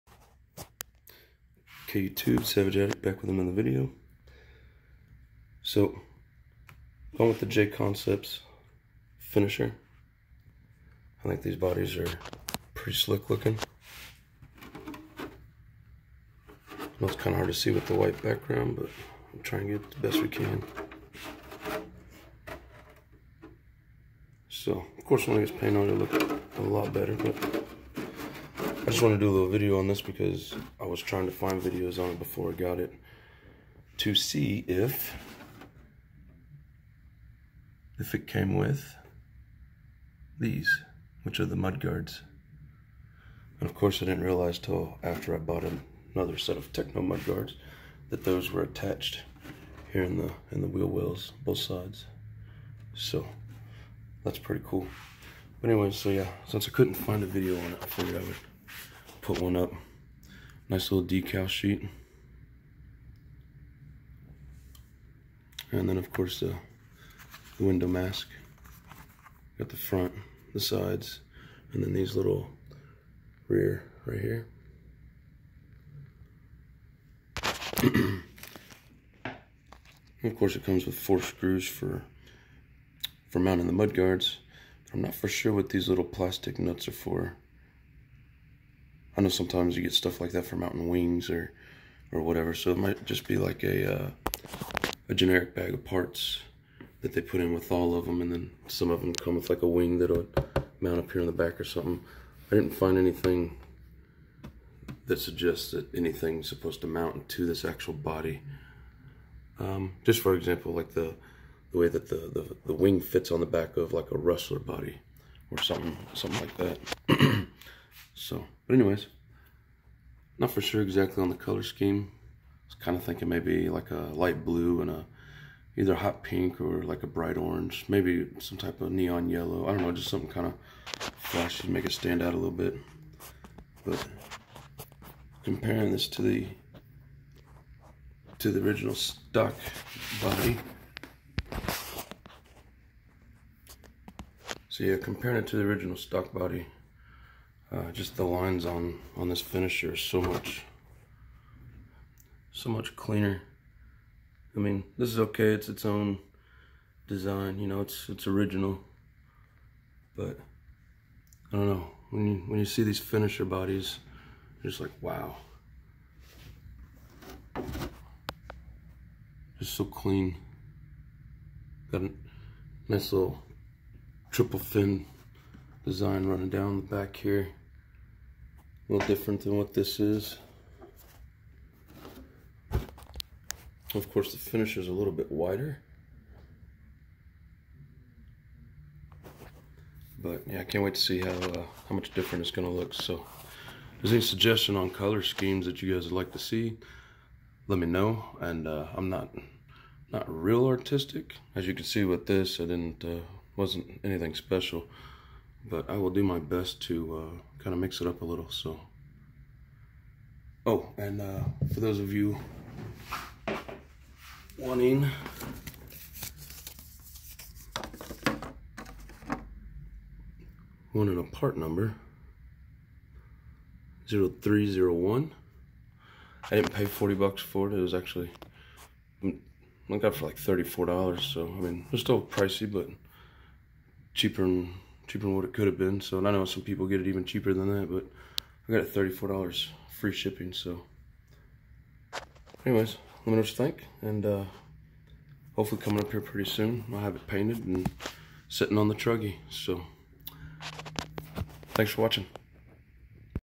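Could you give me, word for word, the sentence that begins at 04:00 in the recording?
So anyways, let me know what you think.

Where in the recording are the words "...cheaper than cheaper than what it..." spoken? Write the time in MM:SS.
03:54.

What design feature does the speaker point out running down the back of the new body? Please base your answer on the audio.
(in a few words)
triple fin design.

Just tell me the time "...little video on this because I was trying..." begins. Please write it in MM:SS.
00:29.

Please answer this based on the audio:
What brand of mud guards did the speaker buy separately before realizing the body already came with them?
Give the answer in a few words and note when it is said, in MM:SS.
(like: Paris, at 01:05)
Tekno, at 00:46.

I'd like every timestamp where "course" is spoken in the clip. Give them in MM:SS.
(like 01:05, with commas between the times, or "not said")
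00:25, 00:43, 01:06, 01:20, 03:04.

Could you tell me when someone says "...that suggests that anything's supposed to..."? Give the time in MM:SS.
01:45.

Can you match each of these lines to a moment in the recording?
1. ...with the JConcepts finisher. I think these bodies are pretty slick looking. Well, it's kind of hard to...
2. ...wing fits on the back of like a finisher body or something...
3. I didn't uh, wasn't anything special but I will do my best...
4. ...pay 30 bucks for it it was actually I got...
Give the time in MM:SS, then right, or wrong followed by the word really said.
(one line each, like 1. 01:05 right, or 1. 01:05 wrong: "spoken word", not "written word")
1. 00:07 right
2. 01:52 wrong: "rustler", not "finisher"
3. 03:22 right
4. 03:46 wrong: "40", not "30".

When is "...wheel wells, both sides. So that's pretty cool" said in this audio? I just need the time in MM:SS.
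00:50.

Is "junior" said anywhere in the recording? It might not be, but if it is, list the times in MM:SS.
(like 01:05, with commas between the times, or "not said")
not said.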